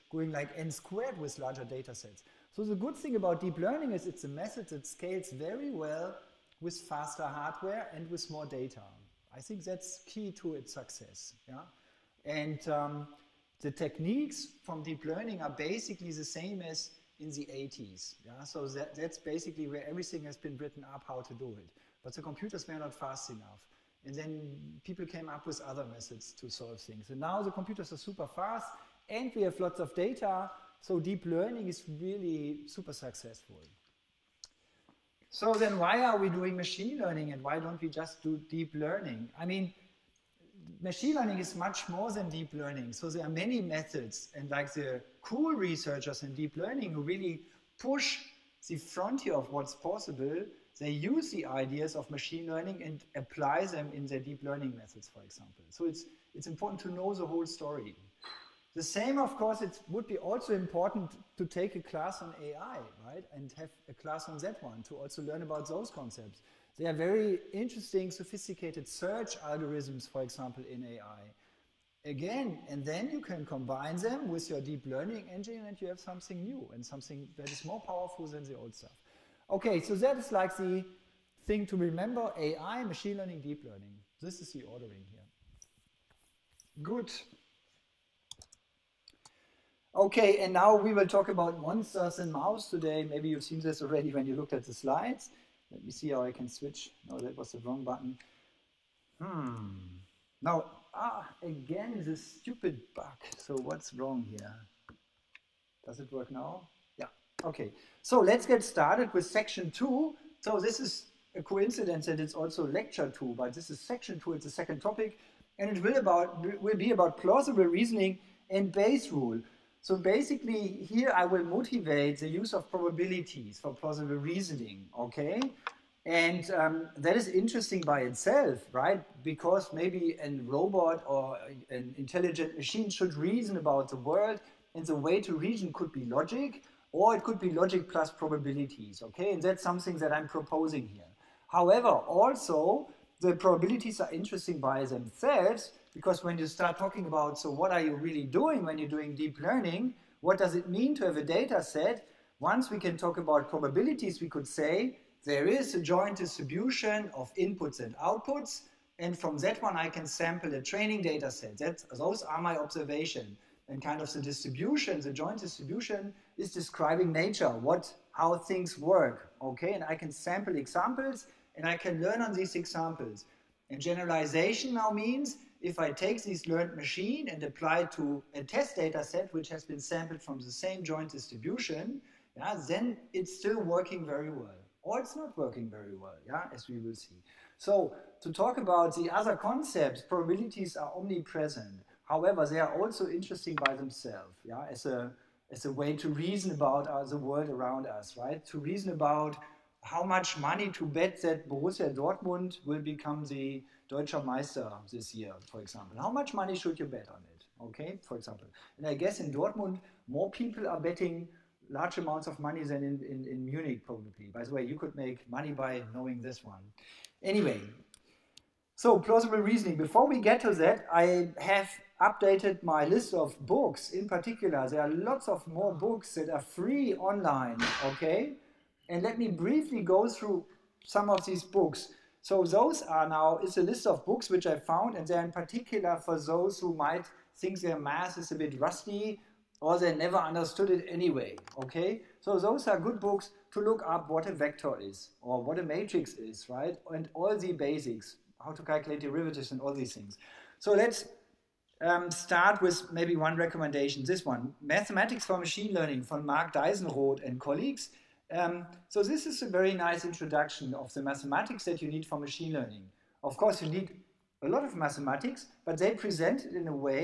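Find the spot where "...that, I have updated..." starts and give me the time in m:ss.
3:40.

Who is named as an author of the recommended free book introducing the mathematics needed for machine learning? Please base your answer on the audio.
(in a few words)
Marc Deisenroth.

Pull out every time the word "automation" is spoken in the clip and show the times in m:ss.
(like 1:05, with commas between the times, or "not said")
not said.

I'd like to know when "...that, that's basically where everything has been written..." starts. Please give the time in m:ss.
0:18.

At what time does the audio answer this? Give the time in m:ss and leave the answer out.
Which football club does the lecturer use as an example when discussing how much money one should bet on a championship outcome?
3:21.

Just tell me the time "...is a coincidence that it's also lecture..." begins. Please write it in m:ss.
1:50.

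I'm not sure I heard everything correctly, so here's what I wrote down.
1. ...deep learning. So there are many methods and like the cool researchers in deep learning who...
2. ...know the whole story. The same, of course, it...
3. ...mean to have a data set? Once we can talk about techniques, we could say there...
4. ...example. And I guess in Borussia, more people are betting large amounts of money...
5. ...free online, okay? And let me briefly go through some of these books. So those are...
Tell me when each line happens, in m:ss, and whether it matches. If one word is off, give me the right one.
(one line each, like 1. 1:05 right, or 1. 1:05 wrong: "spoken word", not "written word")
1. 0:42 right
2. 0:56 right
3. 2:30 wrong: "probabilities", not "techniques"
4. 3:28 wrong: "Dortmund", not "Borussia"
5. 3:46 right.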